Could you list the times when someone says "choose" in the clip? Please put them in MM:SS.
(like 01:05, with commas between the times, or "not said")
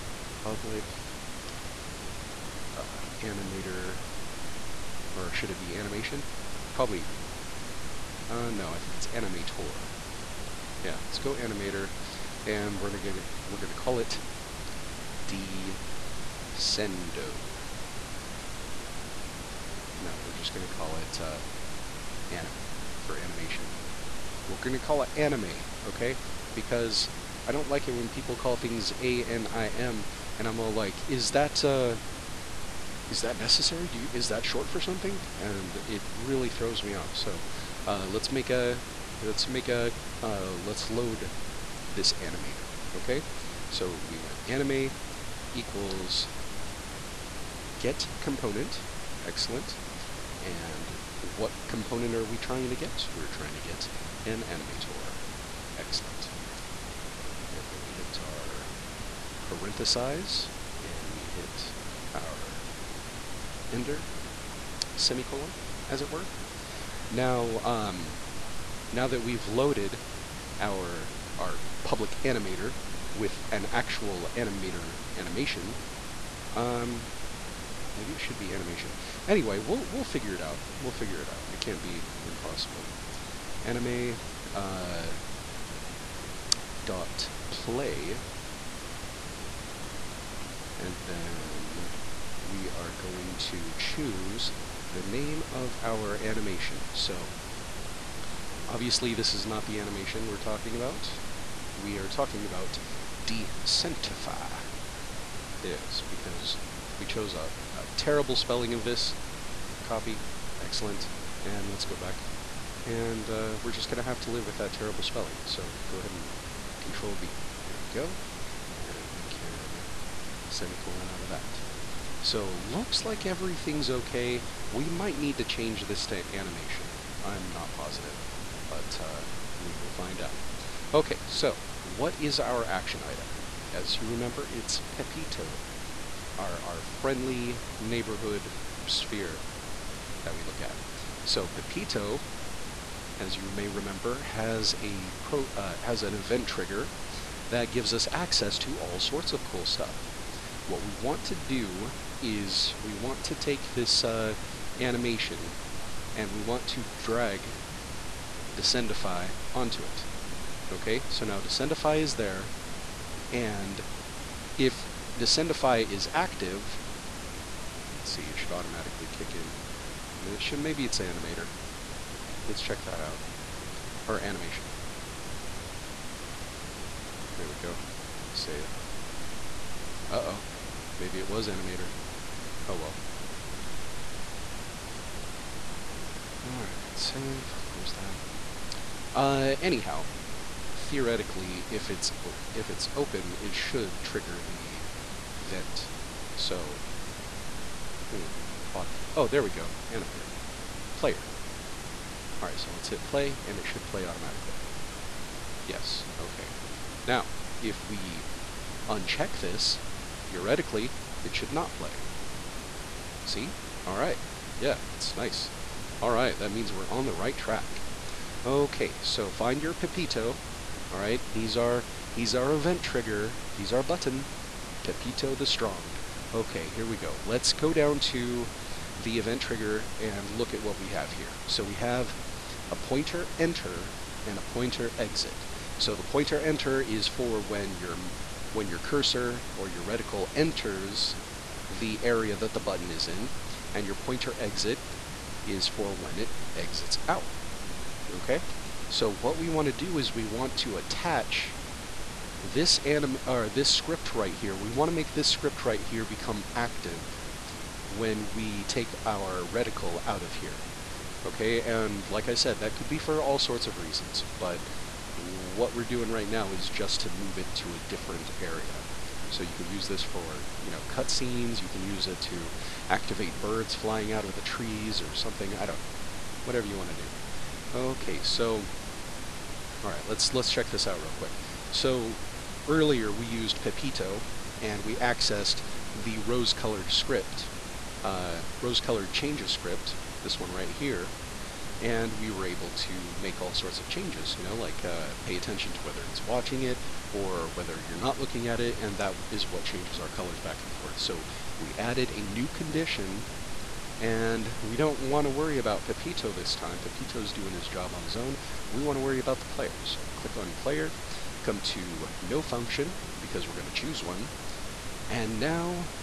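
01:33, 05:13.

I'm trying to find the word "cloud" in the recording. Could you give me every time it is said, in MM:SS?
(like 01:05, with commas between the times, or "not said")
not said.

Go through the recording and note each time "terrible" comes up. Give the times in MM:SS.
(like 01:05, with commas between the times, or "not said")
01:47, 01:54.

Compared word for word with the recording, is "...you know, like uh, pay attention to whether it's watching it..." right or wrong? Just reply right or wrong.
right.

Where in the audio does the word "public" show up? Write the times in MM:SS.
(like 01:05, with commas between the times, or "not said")
00:00, 01:11.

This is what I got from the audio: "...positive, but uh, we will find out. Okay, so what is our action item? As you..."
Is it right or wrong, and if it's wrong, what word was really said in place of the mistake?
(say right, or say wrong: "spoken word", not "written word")
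right.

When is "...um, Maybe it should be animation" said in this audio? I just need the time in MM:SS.
01:16.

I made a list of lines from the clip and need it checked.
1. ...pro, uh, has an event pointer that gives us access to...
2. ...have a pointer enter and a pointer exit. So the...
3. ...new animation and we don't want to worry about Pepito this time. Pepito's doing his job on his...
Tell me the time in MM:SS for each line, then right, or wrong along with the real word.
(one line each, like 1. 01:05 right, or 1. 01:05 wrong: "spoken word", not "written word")
1. 02:25 wrong: "trigger", not "pointer"
2. 03:51 right
3. 05:02 wrong: "condition", not "animation".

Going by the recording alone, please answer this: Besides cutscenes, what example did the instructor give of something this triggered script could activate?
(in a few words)
birds flying.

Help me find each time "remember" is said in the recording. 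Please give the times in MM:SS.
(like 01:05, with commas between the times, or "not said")
02:14, 02:23.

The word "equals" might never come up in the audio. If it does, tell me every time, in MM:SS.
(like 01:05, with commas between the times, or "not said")
00:45.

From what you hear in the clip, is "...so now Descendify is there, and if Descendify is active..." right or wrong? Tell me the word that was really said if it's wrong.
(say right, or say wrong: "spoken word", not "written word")
right.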